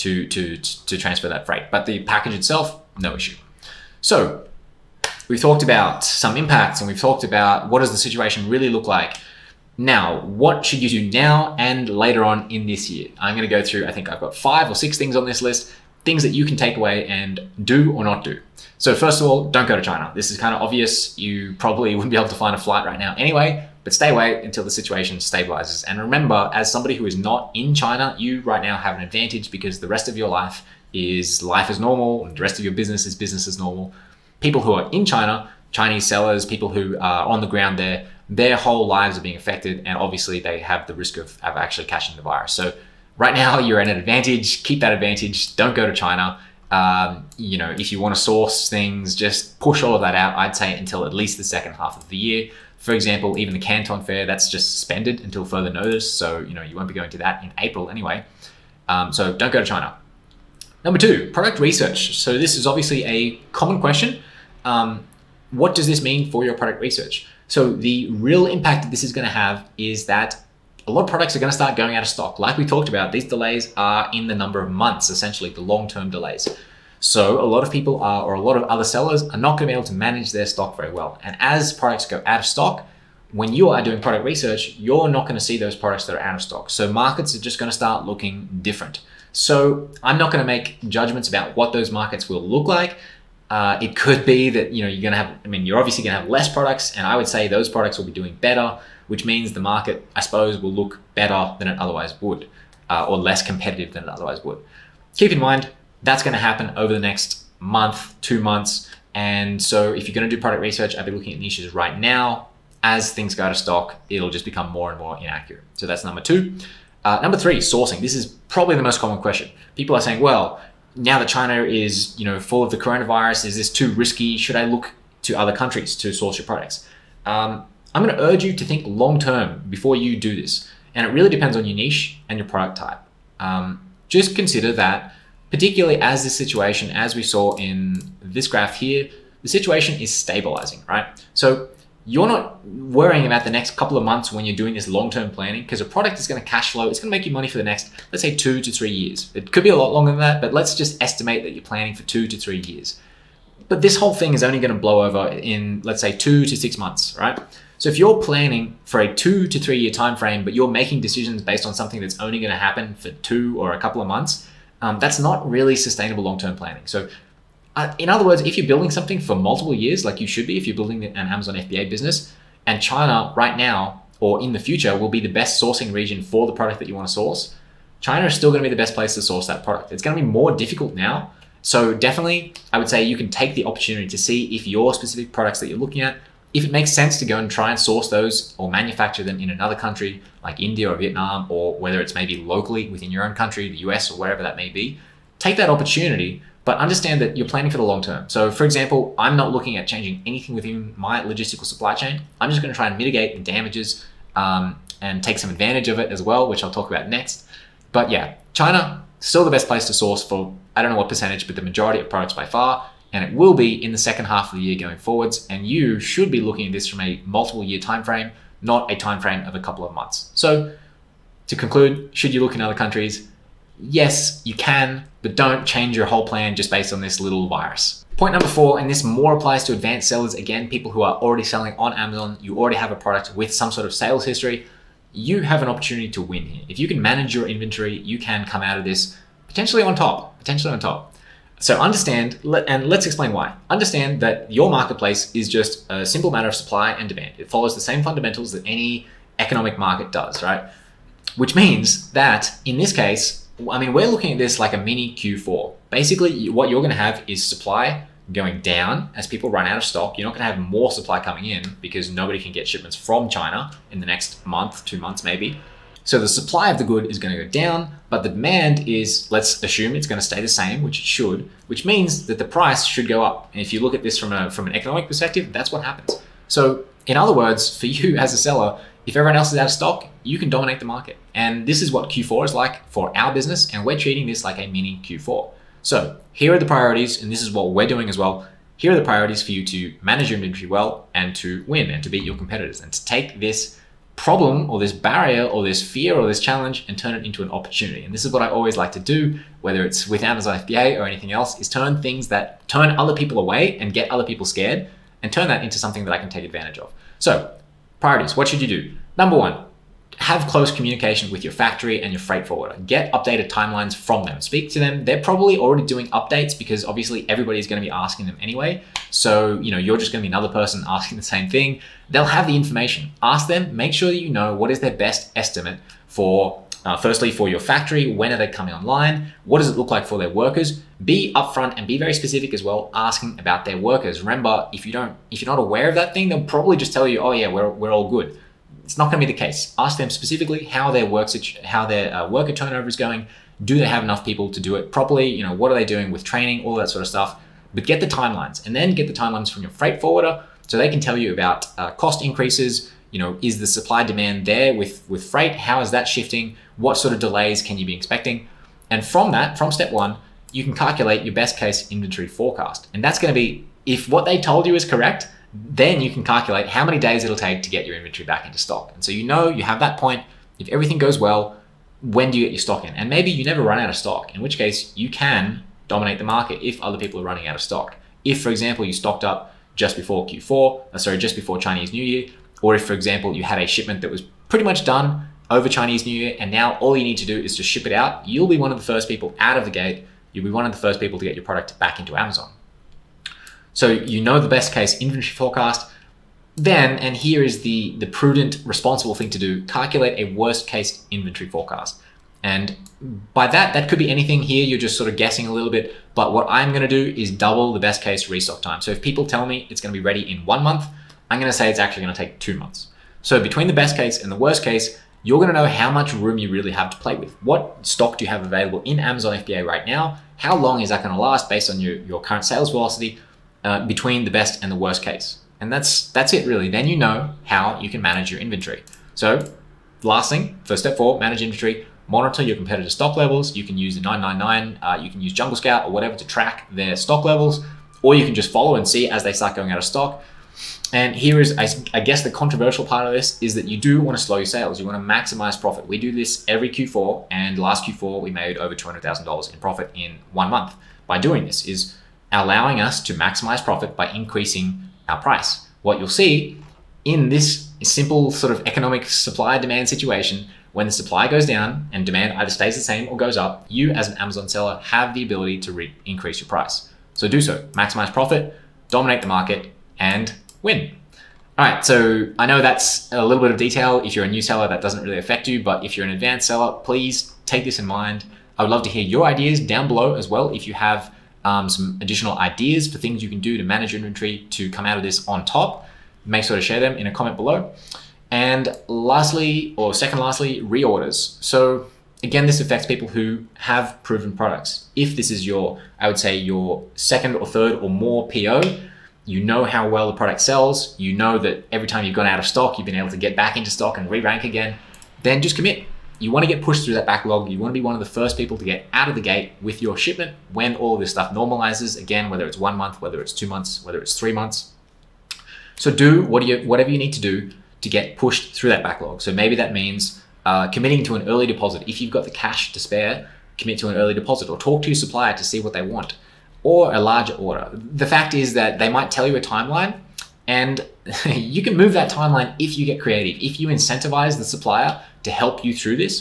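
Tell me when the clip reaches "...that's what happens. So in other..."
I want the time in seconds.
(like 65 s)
275 s.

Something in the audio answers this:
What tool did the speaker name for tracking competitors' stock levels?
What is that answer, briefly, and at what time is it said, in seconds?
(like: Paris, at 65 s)
Jungle Scout, at 435 s.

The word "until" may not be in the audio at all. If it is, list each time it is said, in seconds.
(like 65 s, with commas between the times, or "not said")
24 s, 50 s, 55 s.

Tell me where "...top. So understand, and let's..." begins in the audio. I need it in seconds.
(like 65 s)
240 s.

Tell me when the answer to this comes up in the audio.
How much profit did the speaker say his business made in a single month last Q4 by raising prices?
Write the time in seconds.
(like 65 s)
448 s.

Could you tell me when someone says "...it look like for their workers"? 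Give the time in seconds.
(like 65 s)
329 s.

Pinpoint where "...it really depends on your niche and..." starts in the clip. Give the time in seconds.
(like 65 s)
131 s.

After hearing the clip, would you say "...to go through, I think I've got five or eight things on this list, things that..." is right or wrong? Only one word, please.
wrong.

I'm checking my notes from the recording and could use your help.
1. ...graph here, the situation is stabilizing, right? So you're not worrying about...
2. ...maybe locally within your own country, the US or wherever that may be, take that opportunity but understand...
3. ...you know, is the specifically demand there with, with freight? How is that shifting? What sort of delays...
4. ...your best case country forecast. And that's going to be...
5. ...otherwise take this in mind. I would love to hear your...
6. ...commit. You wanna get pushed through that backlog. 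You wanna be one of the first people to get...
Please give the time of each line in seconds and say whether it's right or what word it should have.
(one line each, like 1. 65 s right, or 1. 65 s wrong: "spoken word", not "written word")
1. 138 s right
2. 192 s right
3. 353 s wrong: "supply", not "specifically"
4. 361 s wrong: "inventory", not "country"
5. 476 s wrong: "please", not "otherwise"
6. 505 s right.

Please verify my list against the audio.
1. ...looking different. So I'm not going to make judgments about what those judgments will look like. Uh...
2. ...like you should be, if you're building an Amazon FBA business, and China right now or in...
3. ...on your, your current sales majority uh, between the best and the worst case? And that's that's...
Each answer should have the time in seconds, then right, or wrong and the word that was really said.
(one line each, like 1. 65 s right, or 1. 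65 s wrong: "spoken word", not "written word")
1. 88 s wrong: "markets", not "judgments"
2. 170 s right
3. 421 s wrong: "velocity", not "majority".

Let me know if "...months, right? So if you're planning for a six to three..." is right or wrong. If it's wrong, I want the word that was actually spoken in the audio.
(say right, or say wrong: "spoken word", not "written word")
wrong: "two", not "six".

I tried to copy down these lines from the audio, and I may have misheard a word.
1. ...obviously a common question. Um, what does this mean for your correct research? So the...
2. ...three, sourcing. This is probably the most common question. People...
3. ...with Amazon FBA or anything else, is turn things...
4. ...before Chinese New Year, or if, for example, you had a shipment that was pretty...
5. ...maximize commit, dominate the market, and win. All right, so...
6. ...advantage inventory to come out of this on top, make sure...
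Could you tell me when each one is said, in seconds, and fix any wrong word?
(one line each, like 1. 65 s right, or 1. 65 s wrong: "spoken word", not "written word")
1. 62 s wrong: "product", not "correct"
2. 117 s right
3. 300 s right
4. 381 s right
5. 467 s wrong: "profit", not "commit"
6. 483 s wrong: "manage", not "advantage".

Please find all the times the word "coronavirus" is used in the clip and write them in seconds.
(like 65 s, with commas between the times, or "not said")
122 s.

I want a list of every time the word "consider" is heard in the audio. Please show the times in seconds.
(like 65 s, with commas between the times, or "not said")
134 s.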